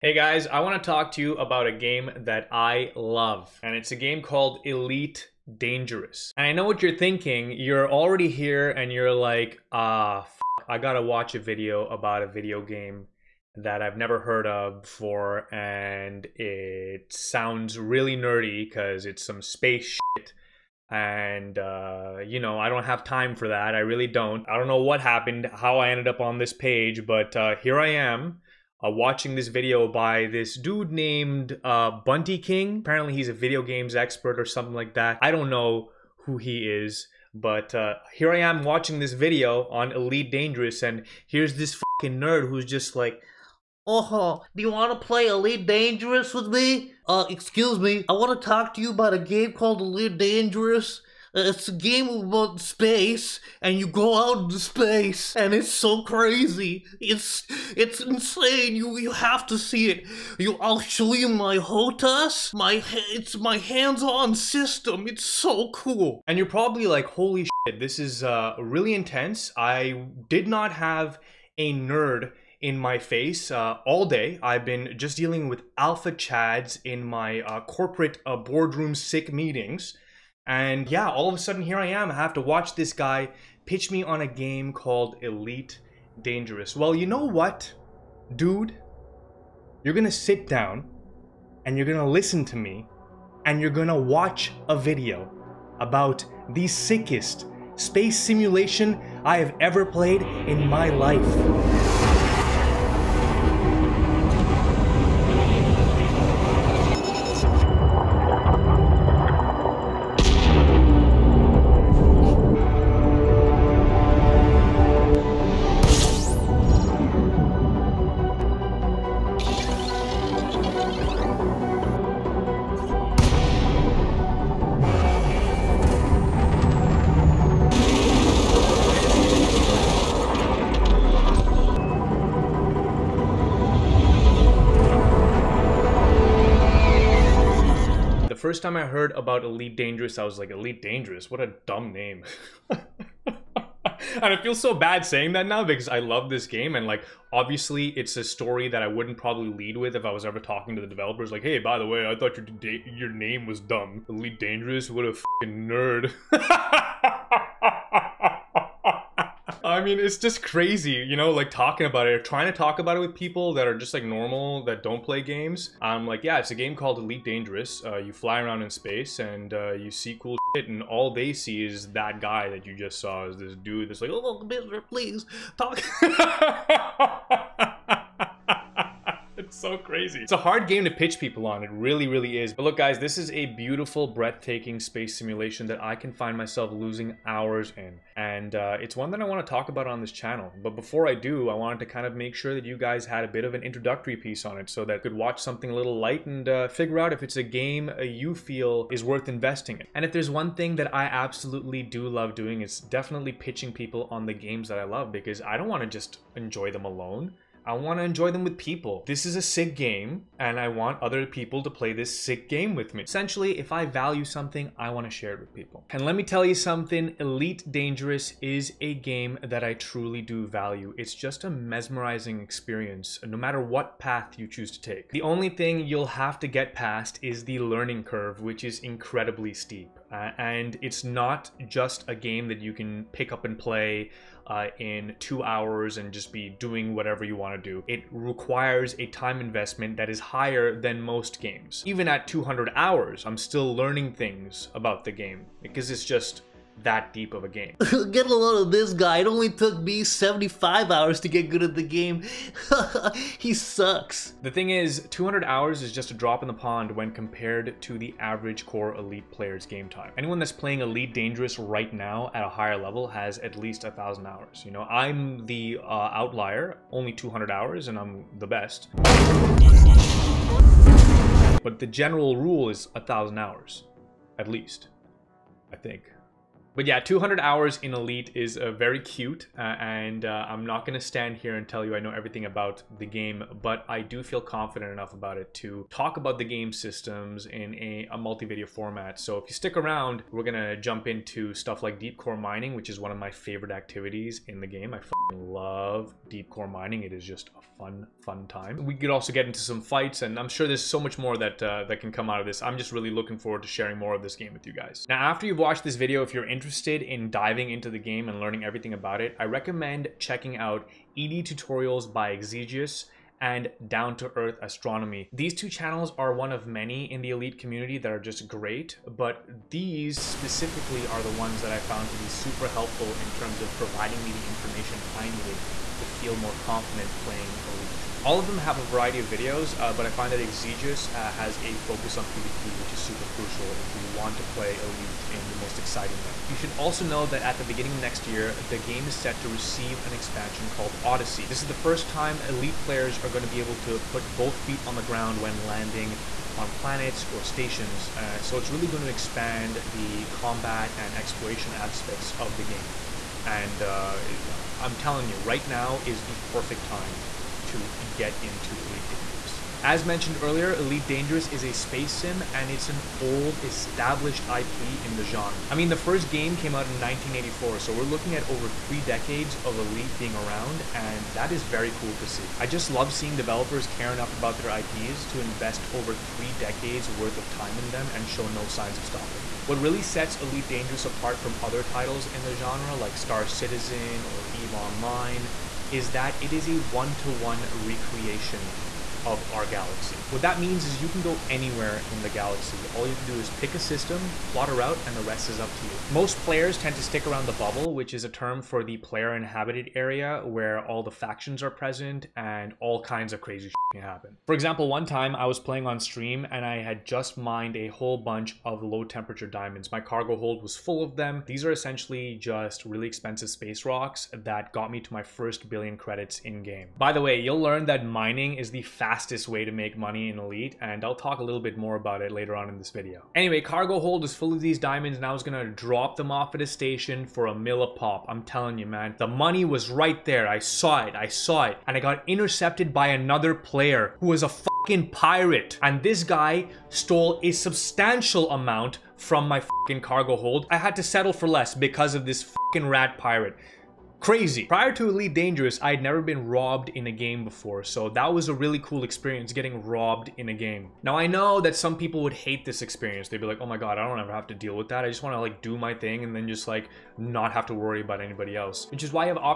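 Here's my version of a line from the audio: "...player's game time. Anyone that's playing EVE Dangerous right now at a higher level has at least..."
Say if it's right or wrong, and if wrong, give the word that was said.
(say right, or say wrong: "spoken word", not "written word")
wrong: "Elite", not "EVE".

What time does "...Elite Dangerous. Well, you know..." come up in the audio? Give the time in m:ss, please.
1:25.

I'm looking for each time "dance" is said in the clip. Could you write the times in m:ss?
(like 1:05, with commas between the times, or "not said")
not said.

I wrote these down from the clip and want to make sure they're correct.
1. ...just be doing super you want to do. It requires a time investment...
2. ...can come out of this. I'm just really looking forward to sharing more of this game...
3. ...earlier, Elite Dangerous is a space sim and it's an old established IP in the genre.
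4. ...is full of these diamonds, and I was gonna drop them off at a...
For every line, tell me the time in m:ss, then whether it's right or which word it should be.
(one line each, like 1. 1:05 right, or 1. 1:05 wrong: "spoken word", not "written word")
1. 3:56 wrong: "whatever", not "super"
2. 5:02 right
3. 6:00 right
4. 7:04 right.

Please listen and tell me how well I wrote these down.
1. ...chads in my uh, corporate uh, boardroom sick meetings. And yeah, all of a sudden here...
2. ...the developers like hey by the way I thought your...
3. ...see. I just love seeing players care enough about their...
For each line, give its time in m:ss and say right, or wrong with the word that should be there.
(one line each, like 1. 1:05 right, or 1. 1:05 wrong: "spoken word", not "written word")
1. 1:16 right
2. 2:30 right
3. 6:12 wrong: "developers", not "players".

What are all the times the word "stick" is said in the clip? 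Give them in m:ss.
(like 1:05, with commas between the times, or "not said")
4:49, 6:37.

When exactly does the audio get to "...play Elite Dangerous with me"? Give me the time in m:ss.
0:45.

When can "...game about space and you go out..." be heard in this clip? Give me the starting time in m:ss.
0:51.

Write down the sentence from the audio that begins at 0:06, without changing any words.
And I know what you're thinking.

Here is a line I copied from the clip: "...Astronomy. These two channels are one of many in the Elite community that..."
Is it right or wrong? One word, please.
right.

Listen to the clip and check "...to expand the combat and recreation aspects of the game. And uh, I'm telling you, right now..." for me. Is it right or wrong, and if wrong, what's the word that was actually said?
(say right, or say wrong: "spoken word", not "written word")
wrong: "exploration", not "recreation".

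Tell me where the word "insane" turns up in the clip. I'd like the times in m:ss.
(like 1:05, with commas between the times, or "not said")
0:57.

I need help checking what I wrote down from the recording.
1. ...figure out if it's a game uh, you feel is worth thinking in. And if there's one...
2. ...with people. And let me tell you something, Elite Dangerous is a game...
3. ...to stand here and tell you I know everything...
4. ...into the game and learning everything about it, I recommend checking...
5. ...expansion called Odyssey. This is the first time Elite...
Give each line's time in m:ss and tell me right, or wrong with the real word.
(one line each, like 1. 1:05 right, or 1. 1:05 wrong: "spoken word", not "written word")
1. 3:16 wrong: "investing", not "thinking"
2. 3:35 right
3. 4:40 right
4. 5:07 right
5. 5:40 right.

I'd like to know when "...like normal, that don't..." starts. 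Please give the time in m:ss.
2:43.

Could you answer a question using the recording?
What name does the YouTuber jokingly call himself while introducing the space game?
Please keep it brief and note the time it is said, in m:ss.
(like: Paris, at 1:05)
Bunty King, at 0:32.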